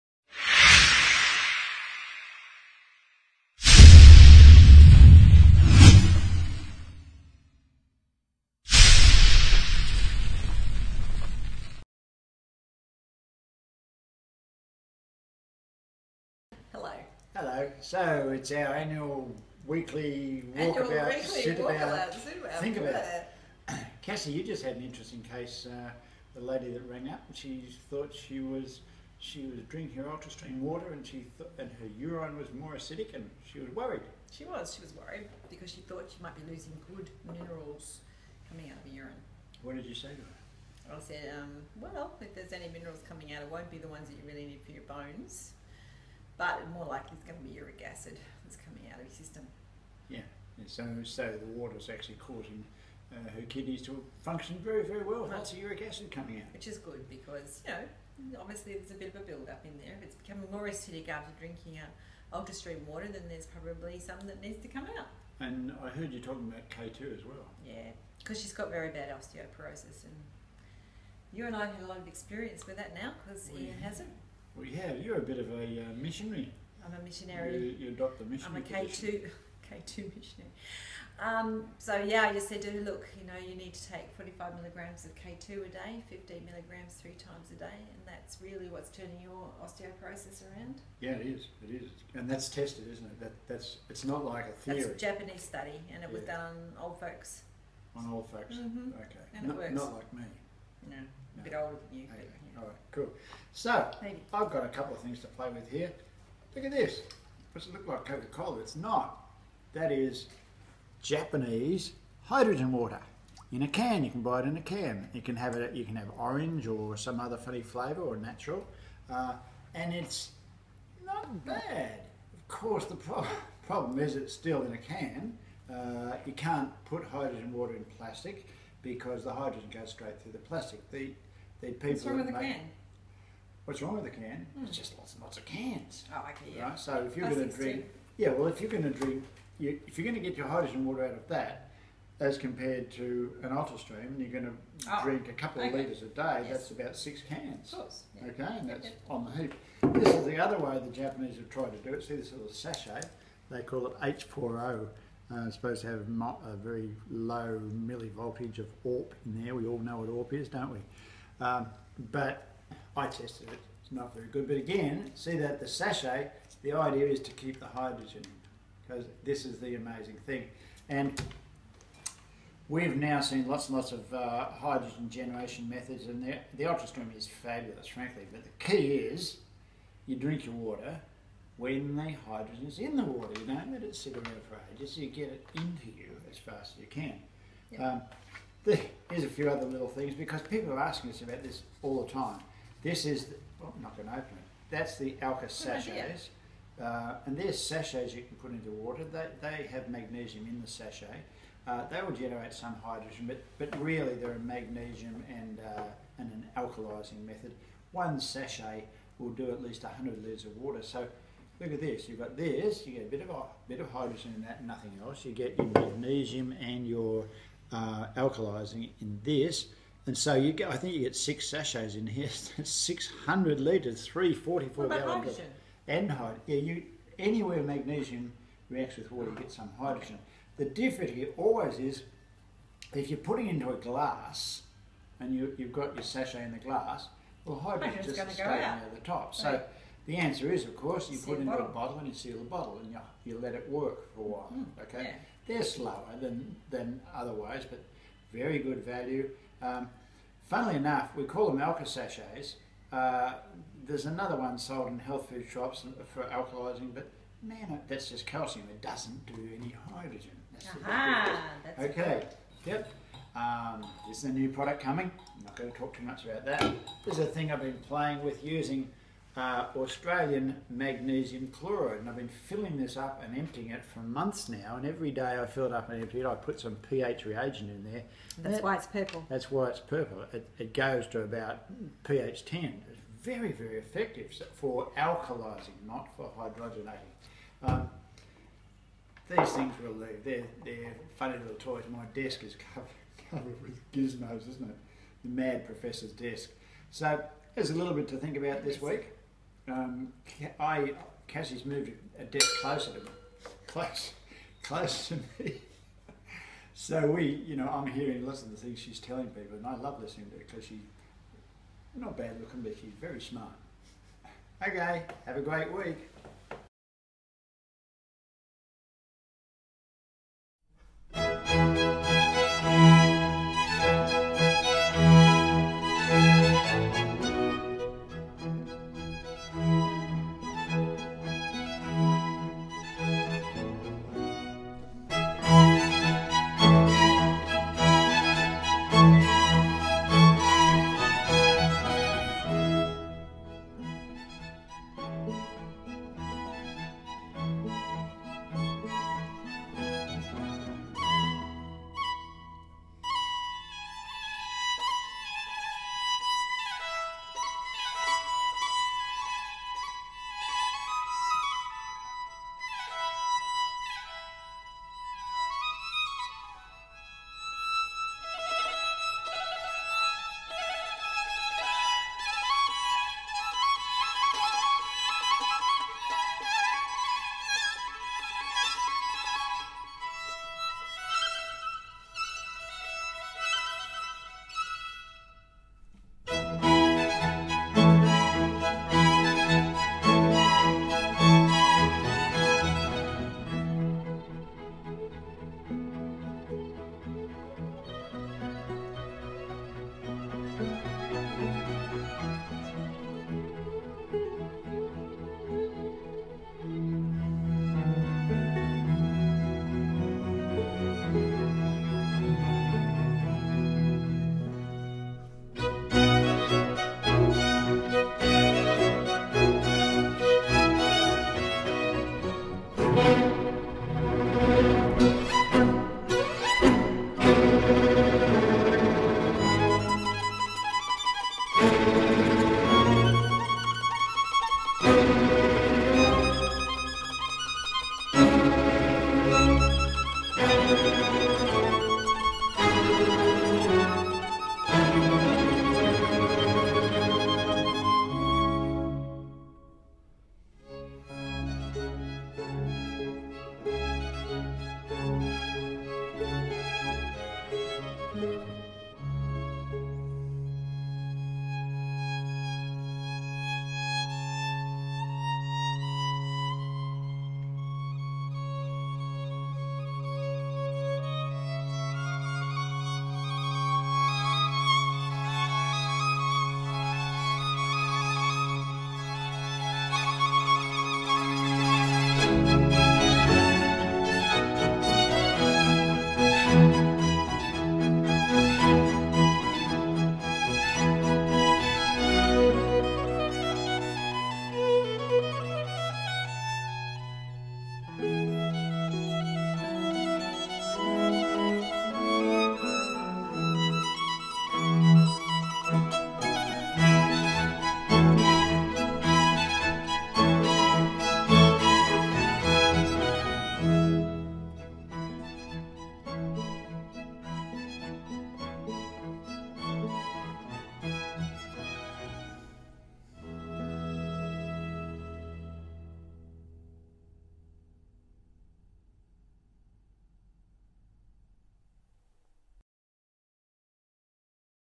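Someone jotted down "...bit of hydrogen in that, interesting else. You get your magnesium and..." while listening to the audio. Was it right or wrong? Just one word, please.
wrong.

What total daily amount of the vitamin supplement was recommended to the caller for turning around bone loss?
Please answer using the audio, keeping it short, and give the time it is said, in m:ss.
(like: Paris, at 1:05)
45 milligrams, at 1:24.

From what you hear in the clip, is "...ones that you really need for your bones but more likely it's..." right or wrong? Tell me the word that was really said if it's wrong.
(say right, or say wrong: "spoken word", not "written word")
right.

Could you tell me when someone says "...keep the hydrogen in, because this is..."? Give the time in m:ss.
2:47.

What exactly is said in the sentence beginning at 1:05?
And I heard you talking about K2 as well.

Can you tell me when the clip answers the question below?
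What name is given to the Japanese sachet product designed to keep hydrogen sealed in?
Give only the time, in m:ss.
2:33.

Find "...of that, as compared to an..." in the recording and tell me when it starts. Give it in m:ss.
2:21.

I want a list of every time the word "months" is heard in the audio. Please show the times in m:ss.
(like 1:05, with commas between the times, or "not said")
4:33.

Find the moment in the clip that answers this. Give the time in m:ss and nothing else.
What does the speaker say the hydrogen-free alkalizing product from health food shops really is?
4:18.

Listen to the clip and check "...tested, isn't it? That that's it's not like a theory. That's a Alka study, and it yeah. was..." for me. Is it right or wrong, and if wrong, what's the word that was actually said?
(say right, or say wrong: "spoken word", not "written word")
wrong: "Japanese", not "Alka".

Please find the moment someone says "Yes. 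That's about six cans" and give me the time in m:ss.
2:26.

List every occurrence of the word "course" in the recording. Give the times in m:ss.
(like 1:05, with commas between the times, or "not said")
2:02, 2:27, 4:00.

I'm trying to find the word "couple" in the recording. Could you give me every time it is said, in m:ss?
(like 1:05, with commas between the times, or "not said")
1:44, 2:25.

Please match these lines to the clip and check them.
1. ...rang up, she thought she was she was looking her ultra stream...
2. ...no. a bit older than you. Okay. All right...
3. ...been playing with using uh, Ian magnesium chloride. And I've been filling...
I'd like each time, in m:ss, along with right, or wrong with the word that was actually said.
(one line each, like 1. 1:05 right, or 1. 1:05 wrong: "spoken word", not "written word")
1. 0:26 wrong: "drinking", not "looking"
2. 1:41 right
3. 4:27 wrong: "Australian", not "Ian".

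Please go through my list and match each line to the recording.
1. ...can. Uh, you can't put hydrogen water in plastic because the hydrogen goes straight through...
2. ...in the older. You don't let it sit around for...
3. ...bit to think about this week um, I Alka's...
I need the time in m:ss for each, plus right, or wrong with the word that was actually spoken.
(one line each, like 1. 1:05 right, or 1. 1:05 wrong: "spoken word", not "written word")
1. 2:04 right
2. 3:02 wrong: "water", not "older"
3. 4:57 wrong: "Cassie", not "Alka".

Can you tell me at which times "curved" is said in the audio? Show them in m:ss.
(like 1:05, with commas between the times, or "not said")
not said.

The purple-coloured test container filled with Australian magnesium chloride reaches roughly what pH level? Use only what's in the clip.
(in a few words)
pH 10.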